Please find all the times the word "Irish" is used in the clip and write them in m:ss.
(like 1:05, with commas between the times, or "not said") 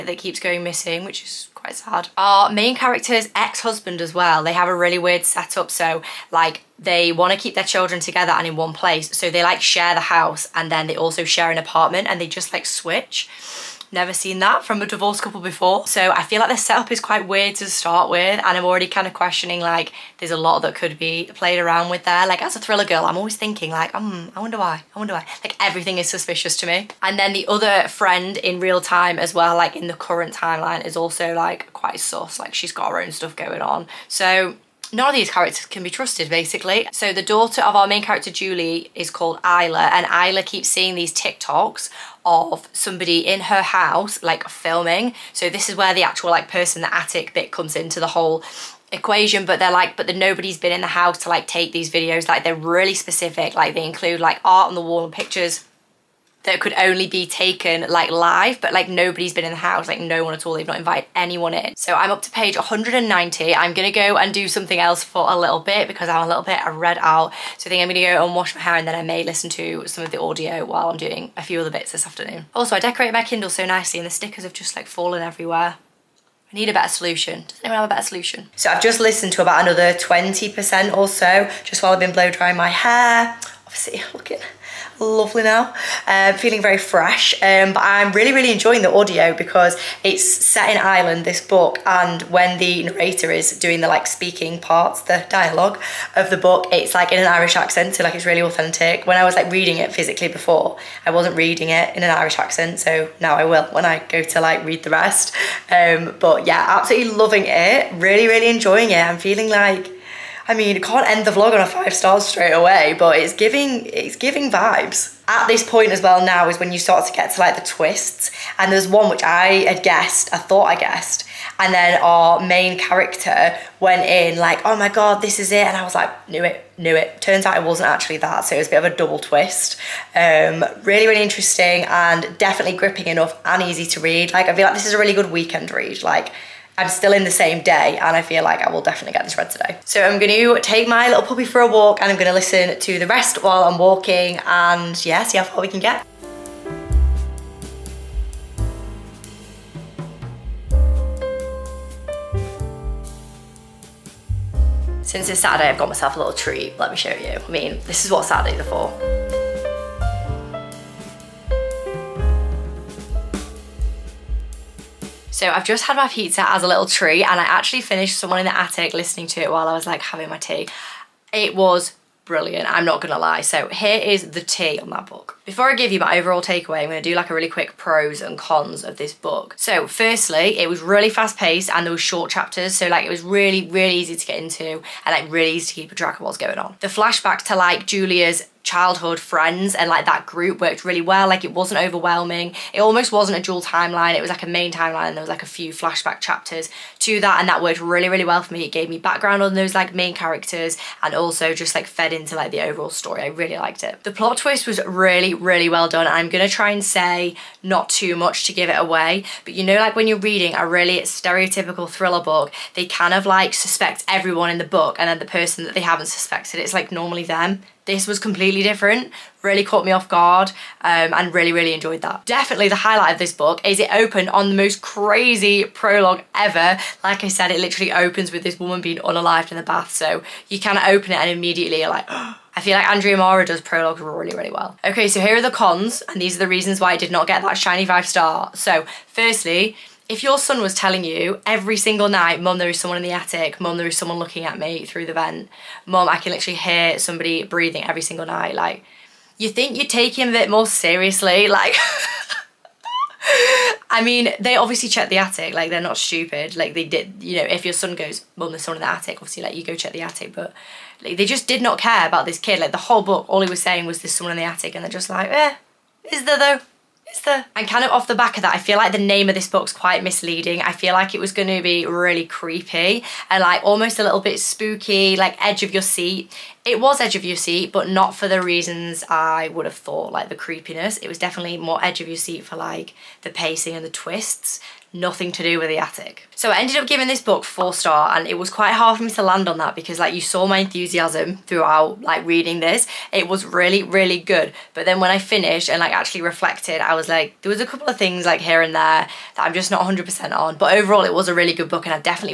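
1:37, 1:42.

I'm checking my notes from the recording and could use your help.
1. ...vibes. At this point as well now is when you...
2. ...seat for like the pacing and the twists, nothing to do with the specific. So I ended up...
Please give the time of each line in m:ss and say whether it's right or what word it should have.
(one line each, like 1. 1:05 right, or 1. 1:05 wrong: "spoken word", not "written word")
1. 1:54 right
2. 4:42 wrong: "attic", not "specific".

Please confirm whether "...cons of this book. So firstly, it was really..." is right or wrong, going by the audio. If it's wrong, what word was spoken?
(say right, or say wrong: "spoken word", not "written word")
right.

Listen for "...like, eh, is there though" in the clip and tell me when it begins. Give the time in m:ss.
4:25.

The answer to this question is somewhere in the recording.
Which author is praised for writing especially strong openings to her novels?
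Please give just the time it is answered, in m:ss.
3:52.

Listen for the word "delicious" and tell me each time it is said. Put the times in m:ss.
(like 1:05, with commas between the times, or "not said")
not said.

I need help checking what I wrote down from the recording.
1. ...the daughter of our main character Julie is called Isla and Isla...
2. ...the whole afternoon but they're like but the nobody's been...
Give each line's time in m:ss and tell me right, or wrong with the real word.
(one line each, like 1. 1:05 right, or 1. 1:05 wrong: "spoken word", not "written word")
1. 0:37 right
2. 0:47 wrong: "equation", not "afternoon".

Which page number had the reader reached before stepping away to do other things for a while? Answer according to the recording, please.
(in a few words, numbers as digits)
190.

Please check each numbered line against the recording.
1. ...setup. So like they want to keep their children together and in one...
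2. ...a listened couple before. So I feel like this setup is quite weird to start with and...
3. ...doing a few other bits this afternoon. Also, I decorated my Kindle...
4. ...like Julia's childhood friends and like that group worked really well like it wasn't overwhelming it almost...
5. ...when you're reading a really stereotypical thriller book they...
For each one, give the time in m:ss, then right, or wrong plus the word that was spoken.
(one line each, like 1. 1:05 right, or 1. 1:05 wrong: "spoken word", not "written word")
1. 0:05 right
2. 0:14 wrong: "divorced", not "listened"
3. 1:10 right
4. 3:07 right
5. 3:29 right.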